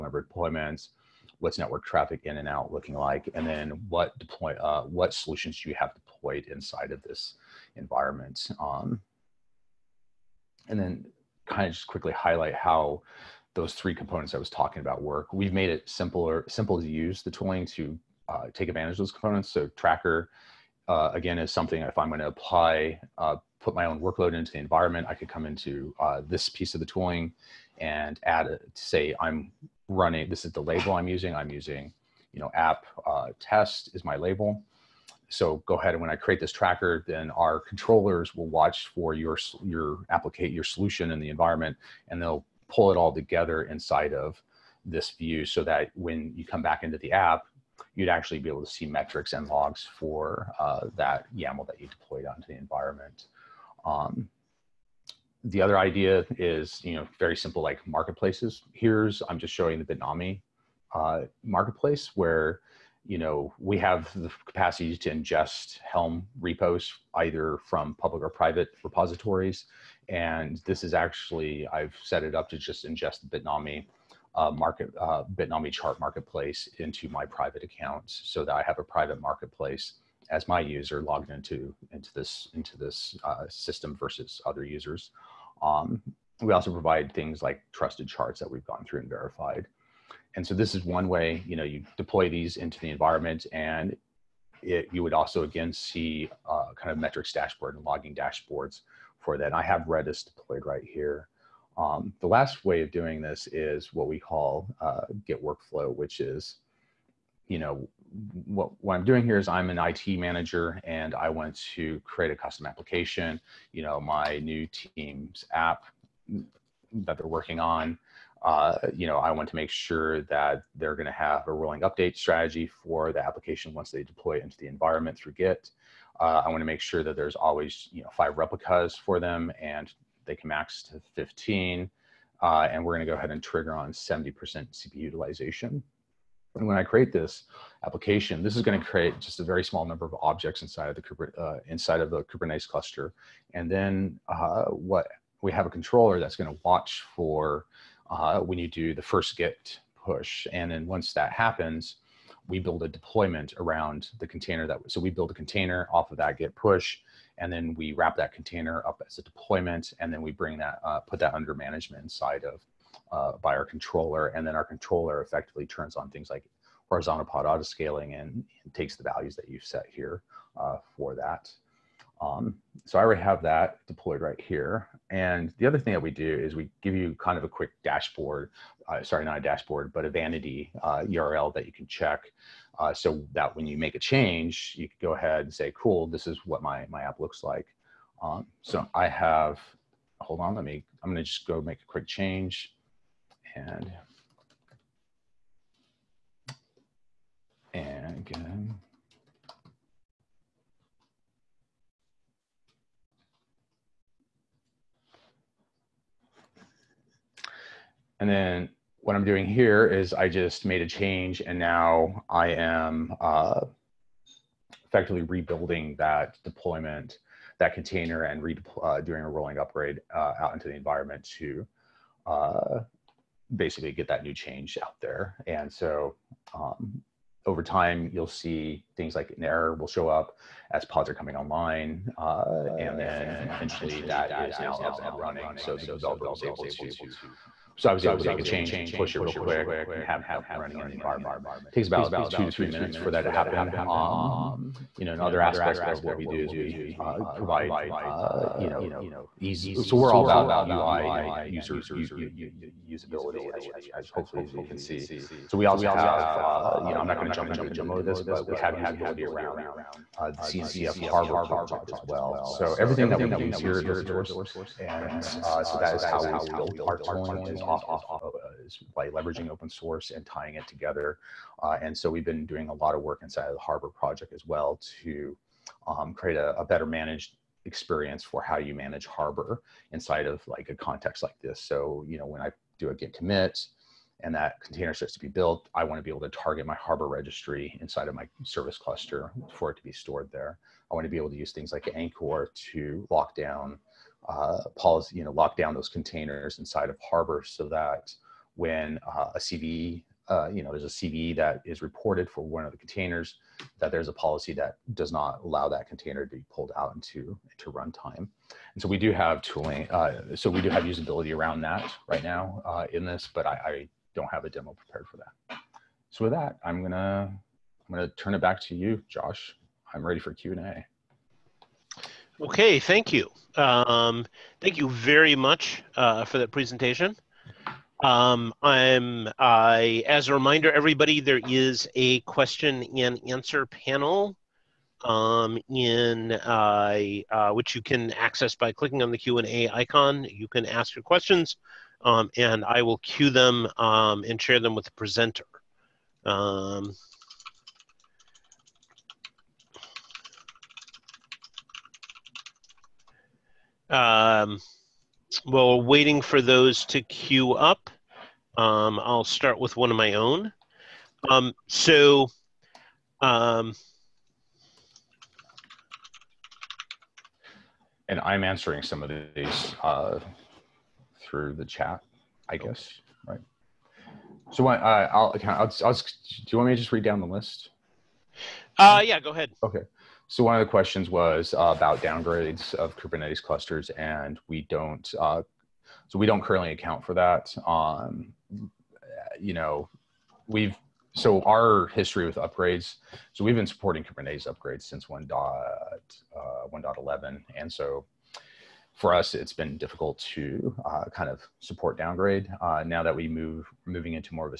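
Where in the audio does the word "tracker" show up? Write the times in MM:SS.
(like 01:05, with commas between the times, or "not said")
00:19, 00:36.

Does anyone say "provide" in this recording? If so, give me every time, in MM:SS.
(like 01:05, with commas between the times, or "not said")
01:26, 04:07.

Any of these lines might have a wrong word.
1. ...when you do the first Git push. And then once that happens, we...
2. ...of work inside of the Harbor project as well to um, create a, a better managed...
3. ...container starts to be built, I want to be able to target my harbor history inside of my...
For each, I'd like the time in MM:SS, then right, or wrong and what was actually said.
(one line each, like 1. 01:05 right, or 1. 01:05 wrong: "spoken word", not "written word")
1. 02:28 right
2. 04:32 right
3. 04:44 wrong: "registry", not "history".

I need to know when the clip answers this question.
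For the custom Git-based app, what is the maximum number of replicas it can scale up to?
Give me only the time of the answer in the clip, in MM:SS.
02:11.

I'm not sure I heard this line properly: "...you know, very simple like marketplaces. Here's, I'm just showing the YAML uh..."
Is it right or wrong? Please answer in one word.
wrong.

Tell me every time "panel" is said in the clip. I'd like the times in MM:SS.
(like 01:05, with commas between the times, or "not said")
05:33.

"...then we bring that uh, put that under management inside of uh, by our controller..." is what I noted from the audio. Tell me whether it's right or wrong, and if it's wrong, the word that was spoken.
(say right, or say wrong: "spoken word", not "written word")
right.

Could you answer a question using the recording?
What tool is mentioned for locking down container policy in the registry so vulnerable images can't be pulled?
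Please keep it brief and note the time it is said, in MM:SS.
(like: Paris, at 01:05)
Anchore, at 04:51.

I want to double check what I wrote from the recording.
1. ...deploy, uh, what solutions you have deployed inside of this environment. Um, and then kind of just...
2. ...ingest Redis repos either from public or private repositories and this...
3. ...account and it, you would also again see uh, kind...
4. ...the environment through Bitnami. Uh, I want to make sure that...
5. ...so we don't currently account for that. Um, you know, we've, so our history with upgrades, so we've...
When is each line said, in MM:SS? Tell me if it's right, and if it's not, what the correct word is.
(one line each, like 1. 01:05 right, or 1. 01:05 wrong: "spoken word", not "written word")
1. 00:04 right
2. 01:05 wrong: "Helm", not "Redis"
3. 01:32 wrong: "environment", not "account"
4. 02:04 wrong: "Git", not "Bitnami"
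5. 06:26 right.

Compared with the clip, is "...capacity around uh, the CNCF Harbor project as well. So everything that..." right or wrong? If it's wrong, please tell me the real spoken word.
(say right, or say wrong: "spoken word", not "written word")
wrong: "usability", not "capacity".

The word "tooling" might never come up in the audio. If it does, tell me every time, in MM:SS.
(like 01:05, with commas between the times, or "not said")
00:17, 00:26, 04:26, 05:09.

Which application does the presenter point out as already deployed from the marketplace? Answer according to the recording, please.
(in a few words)
Redis.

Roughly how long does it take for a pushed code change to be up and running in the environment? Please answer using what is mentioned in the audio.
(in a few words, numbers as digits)
2 to 3 minutes.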